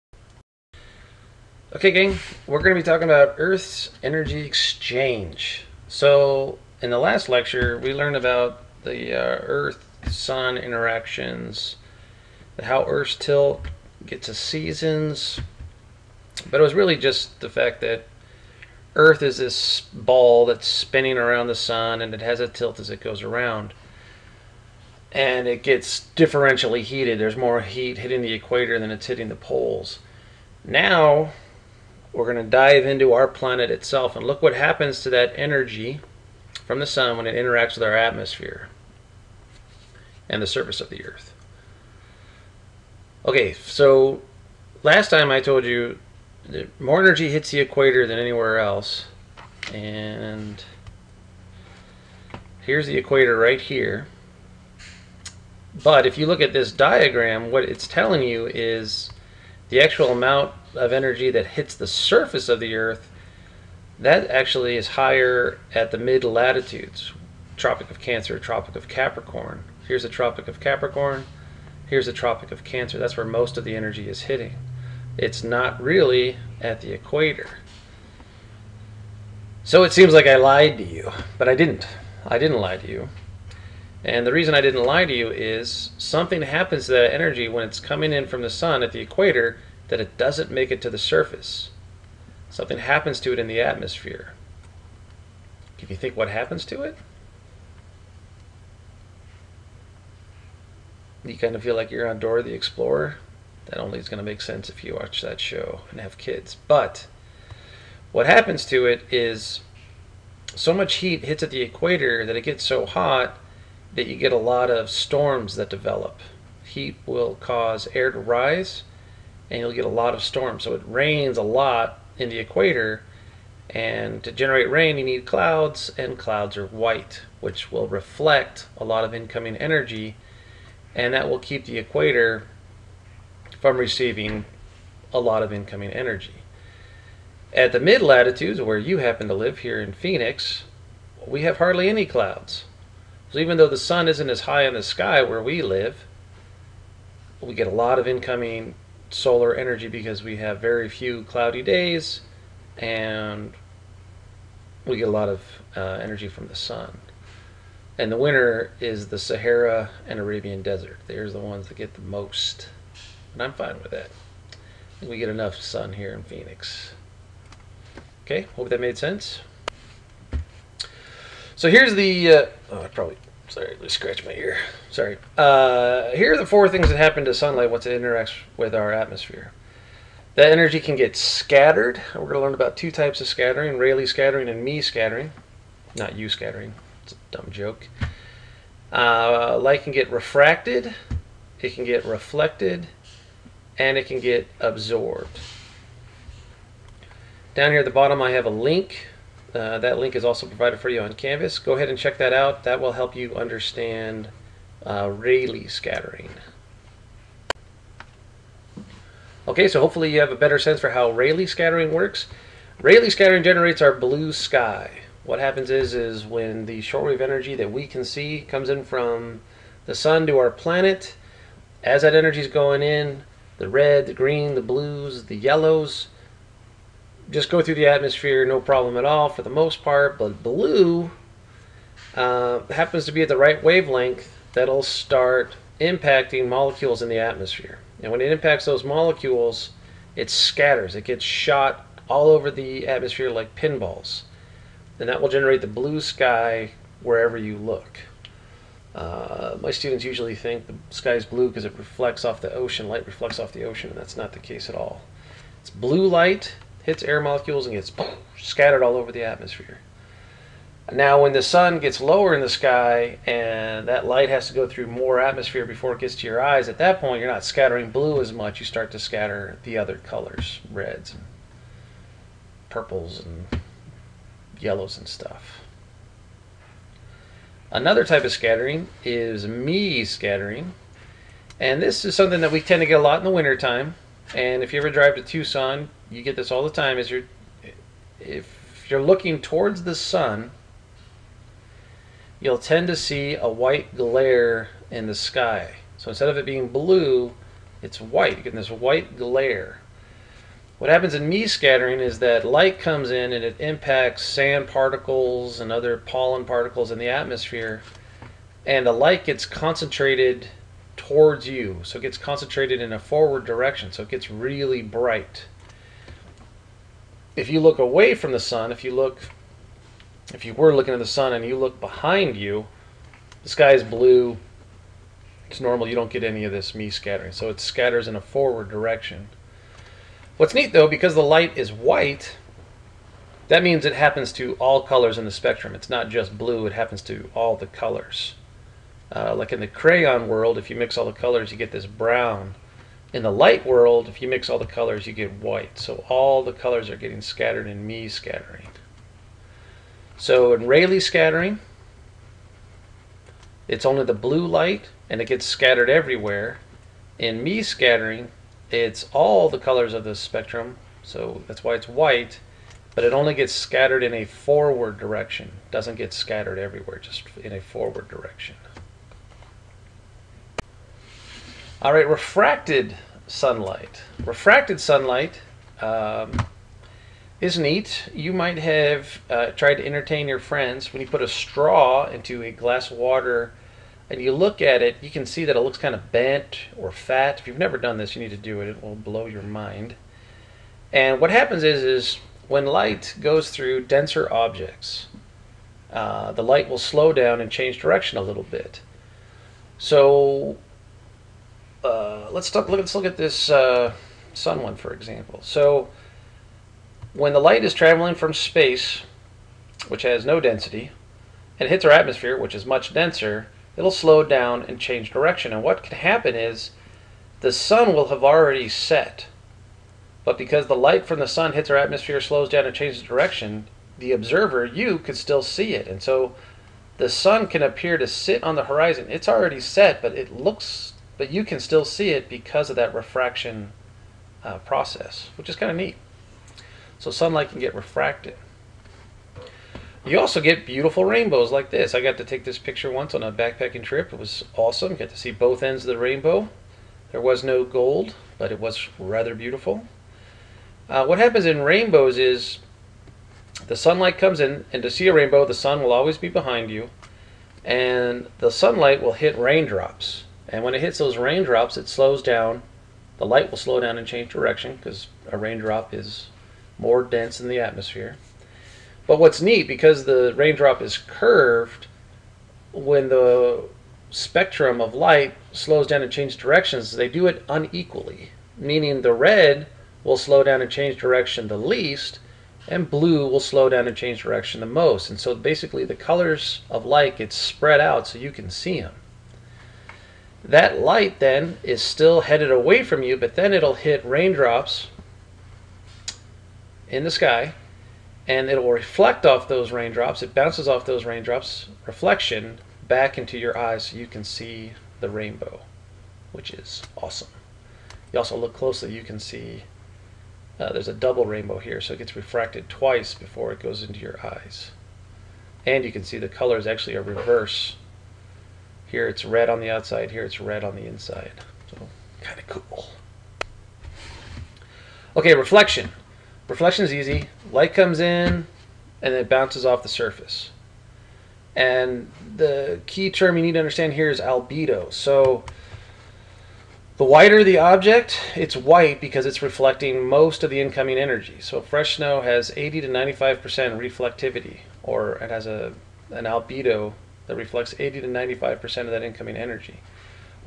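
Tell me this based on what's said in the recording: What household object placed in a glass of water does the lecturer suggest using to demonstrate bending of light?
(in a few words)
a straw.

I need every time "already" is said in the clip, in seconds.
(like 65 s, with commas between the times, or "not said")
418 s, 429 s.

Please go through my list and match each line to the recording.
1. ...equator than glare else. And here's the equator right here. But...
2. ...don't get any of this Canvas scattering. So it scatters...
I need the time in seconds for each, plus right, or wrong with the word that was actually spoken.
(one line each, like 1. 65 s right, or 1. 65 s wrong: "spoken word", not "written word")
1. 47 s wrong: "anywhere", not "glare"
2. 325 s wrong: "Mie", not "Canvas".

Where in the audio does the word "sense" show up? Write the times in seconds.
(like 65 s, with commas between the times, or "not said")
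104 s, 168 s, 210 s.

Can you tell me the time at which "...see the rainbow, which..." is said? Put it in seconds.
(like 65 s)
504 s.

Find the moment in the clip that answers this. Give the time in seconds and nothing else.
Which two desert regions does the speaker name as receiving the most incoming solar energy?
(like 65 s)
159 s.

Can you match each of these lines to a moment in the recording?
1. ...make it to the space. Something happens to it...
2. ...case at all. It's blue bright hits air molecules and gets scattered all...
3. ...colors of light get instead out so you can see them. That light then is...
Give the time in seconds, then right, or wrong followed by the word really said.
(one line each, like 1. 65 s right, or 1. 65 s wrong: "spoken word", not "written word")
1. 90 s wrong: "surface", not "space"
2. 254 s wrong: "light", not "bright"
3. 485 s wrong: "spread", not "instead".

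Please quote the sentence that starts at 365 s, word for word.
Doesn't get scattered everywhere, just in a forward direction.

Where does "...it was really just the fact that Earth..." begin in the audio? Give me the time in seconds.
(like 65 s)
16 s.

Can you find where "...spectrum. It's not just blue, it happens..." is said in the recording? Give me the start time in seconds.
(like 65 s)
335 s.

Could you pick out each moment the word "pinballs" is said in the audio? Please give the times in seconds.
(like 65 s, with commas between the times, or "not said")
243 s.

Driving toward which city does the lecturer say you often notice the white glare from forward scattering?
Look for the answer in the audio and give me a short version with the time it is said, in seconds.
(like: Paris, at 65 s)
Tucson, at 285 s.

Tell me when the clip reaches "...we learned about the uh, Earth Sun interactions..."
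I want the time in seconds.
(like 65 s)
7 s.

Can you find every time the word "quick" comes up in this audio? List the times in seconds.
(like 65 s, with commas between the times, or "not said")
not said.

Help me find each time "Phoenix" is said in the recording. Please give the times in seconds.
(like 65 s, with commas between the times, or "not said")
139 s, 166 s.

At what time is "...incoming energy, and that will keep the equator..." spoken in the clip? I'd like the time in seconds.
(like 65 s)
129 s.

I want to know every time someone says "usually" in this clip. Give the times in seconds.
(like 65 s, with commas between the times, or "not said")
250 s.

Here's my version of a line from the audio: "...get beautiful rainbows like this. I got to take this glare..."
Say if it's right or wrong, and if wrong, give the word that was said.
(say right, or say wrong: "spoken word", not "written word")
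wrong: "picture", not "glare".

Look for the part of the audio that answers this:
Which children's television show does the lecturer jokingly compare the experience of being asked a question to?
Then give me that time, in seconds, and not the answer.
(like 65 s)
102 s.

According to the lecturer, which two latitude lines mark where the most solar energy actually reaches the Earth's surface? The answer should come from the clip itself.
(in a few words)
Tropic of Cancer, Tropic of Capricorn.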